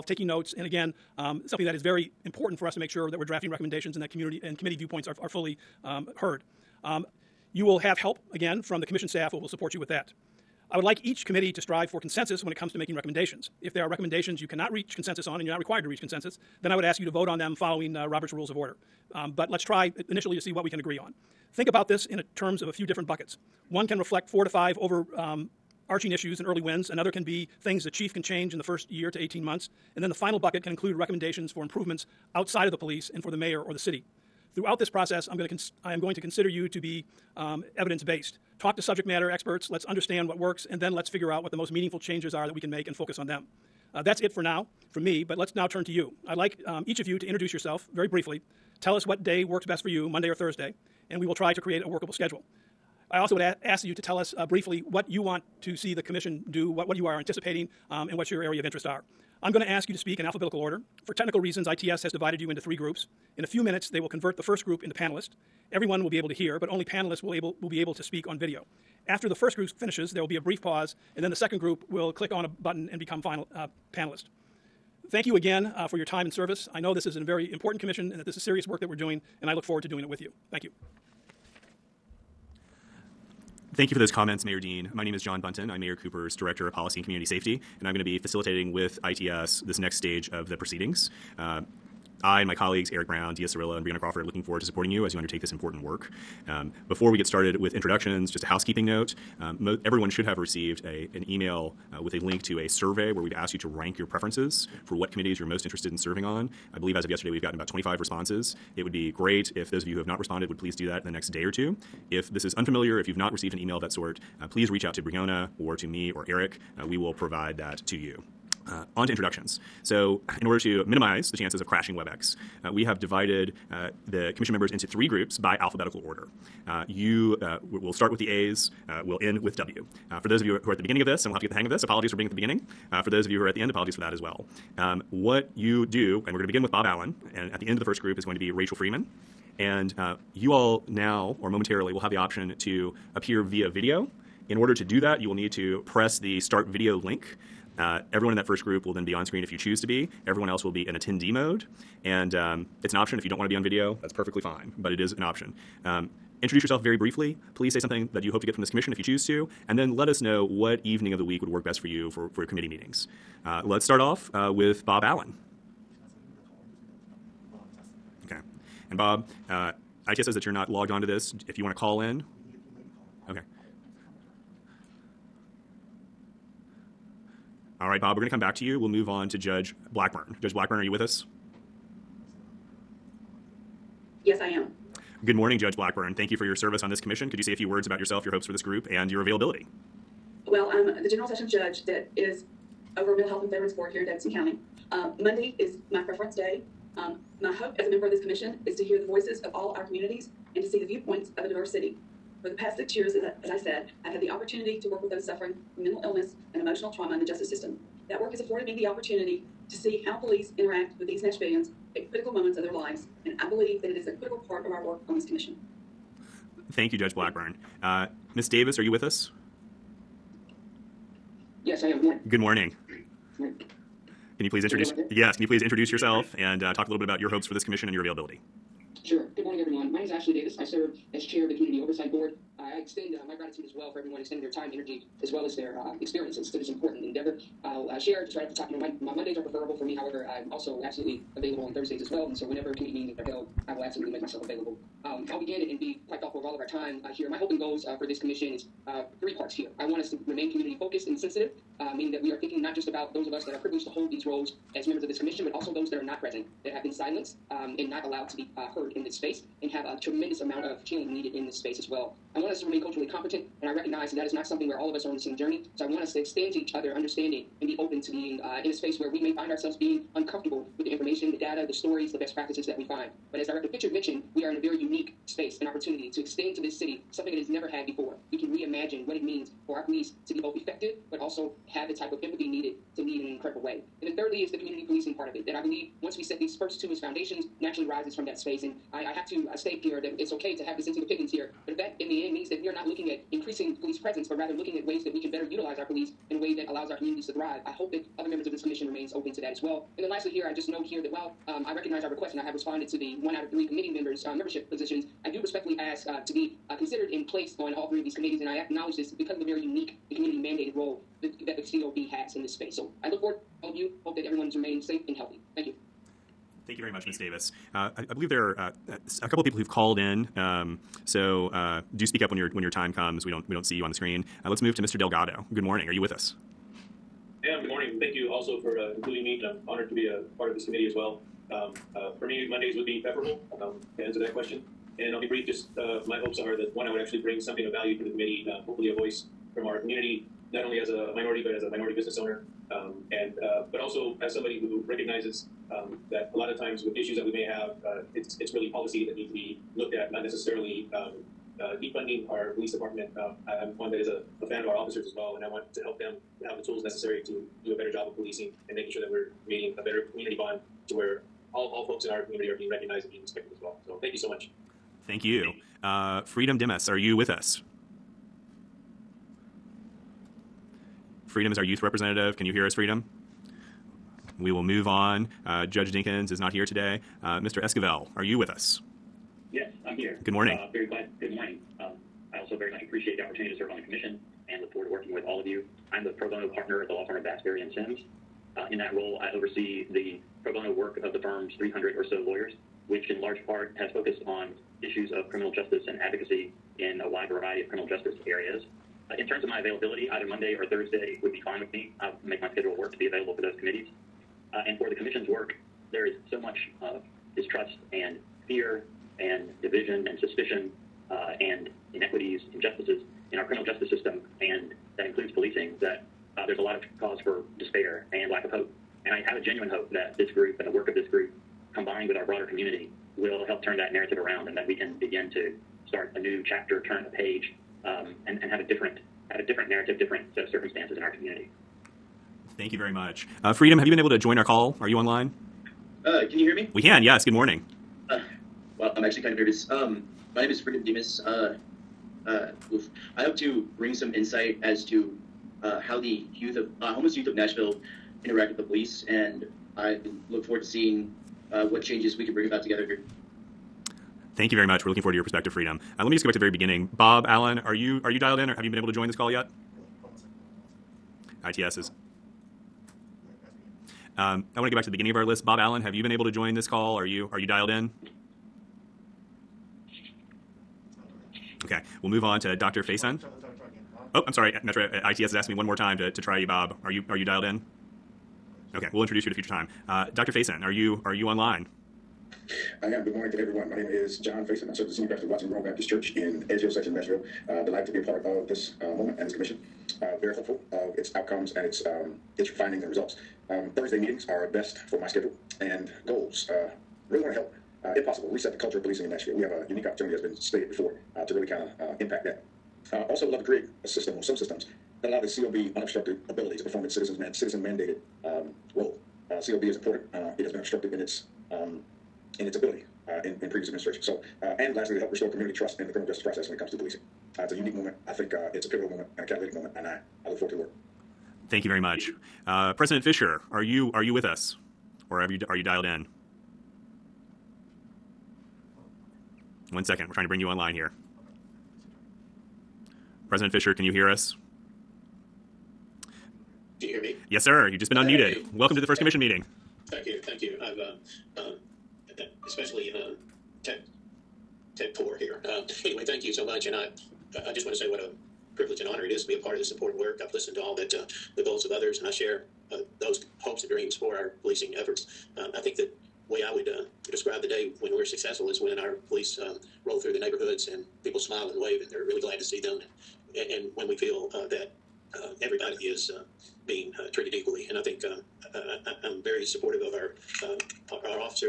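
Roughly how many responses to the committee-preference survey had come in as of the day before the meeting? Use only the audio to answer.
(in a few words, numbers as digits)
25.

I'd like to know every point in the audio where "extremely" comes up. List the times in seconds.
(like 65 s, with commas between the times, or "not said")
not said.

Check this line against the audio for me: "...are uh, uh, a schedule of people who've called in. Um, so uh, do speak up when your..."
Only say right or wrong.
wrong.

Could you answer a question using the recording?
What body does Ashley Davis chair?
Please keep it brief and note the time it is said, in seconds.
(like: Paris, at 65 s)
Community Oversight Board, at 231 s.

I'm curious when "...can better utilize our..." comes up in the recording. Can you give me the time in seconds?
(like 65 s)
295 s.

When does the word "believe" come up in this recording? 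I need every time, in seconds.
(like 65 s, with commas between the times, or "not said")
106 s, 213 s, 285 s, 318 s.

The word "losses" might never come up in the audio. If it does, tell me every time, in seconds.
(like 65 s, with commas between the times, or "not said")
not said.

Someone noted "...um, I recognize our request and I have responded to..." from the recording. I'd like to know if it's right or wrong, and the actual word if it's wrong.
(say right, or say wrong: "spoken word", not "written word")
right.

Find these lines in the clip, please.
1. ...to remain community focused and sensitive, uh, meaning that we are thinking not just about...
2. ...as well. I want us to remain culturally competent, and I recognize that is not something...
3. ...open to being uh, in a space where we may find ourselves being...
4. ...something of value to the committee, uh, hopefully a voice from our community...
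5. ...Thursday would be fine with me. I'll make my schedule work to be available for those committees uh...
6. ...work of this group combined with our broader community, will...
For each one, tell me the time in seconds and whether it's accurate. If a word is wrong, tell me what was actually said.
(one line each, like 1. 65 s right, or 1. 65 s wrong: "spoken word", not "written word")
1. 250 s right
2. 261 s right
3. 267 s right
4. 337 s right
5. 400 s right
6. 420 s right.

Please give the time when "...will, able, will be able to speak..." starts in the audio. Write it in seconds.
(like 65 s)
67 s.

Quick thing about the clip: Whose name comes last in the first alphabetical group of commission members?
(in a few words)
Rachel Freeman.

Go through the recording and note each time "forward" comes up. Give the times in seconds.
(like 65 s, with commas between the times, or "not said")
79 s, 94 s, 313 s, 384 s, 450 s, 455 s, 520 s.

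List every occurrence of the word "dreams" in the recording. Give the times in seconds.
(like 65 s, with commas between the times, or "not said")
553 s.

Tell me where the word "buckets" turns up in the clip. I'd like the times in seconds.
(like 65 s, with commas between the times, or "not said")
23 s, 30 s.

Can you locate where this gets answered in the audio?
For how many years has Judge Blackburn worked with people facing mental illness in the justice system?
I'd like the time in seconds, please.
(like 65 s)
202 s.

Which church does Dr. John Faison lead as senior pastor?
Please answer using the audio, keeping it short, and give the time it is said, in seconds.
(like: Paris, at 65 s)
Watson Grove Baptist Church, at 485 s.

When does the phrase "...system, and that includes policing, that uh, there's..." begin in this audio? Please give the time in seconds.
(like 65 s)
413 s.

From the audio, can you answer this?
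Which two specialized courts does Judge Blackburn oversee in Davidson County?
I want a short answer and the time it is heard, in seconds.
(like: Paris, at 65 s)
Mental Health and Veterans Court, at 193 s.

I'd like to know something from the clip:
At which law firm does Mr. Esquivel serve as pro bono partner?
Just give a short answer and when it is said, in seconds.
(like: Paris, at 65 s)
Bass Berry and Sims, at 387 s.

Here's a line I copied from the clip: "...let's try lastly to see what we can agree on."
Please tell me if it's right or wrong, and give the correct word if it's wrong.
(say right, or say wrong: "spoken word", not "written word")
wrong: "initially", not "lastly".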